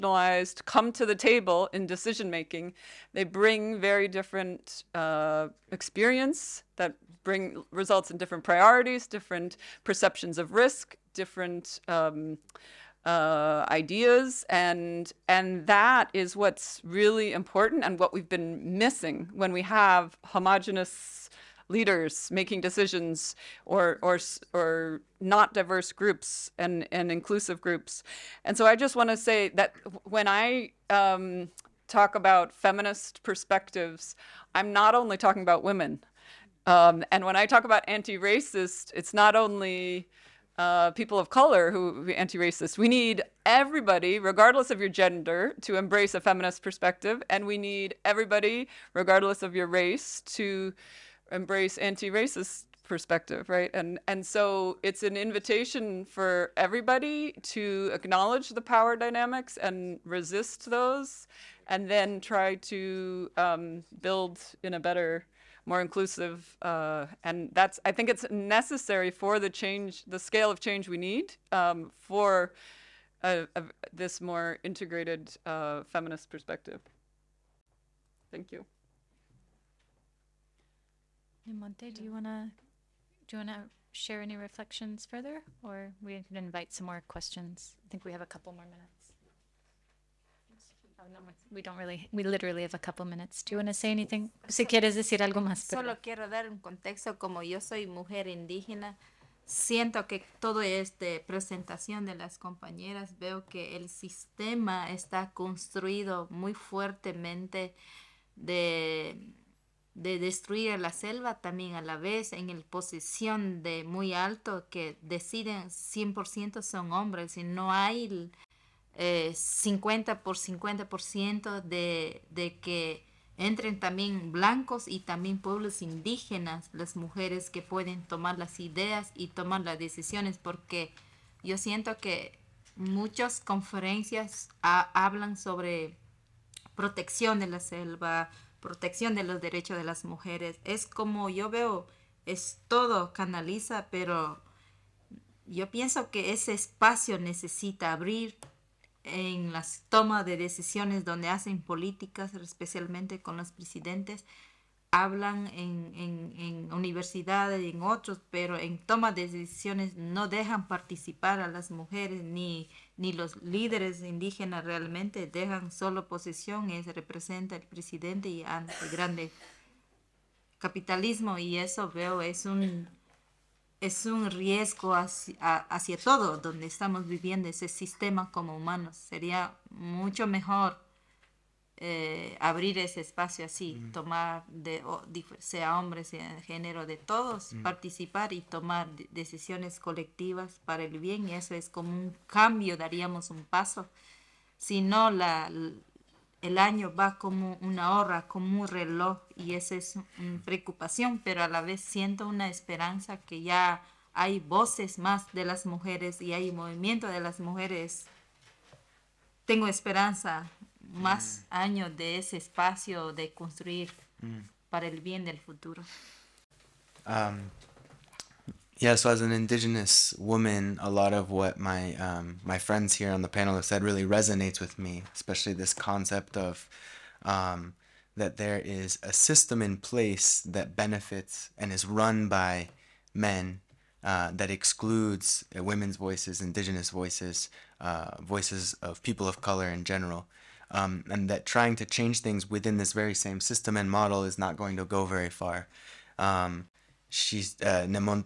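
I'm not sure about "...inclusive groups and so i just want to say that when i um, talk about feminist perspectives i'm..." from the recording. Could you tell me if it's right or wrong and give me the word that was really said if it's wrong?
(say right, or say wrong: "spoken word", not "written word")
right.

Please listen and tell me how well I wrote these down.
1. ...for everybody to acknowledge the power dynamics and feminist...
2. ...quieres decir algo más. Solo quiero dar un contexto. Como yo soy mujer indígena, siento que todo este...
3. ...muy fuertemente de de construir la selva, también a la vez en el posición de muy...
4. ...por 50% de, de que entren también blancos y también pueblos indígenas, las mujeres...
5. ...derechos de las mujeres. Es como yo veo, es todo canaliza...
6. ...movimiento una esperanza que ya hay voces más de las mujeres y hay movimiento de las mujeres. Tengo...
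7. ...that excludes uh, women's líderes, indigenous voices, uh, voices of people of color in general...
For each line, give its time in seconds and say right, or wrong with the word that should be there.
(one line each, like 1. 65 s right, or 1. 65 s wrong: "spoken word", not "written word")
1. 56 s wrong: "resist", not "feminist"
2. 94 s right
3. 106 s wrong: "destruir", not "construir"
4. 120 s right
5. 139 s right
6. 201 s wrong: "siento", not "movimiento"
7. 234 s wrong: "voices", not "líderes".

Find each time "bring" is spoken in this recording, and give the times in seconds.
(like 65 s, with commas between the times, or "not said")
3 s, 7 s.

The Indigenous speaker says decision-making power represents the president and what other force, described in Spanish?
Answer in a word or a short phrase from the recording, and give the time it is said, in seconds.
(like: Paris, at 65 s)
grande capitalismo, at 168 s.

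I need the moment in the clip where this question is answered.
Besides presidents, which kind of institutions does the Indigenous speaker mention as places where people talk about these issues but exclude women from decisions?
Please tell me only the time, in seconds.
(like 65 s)
156 s.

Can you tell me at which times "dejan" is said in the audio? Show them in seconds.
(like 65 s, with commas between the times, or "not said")
160 s, 165 s.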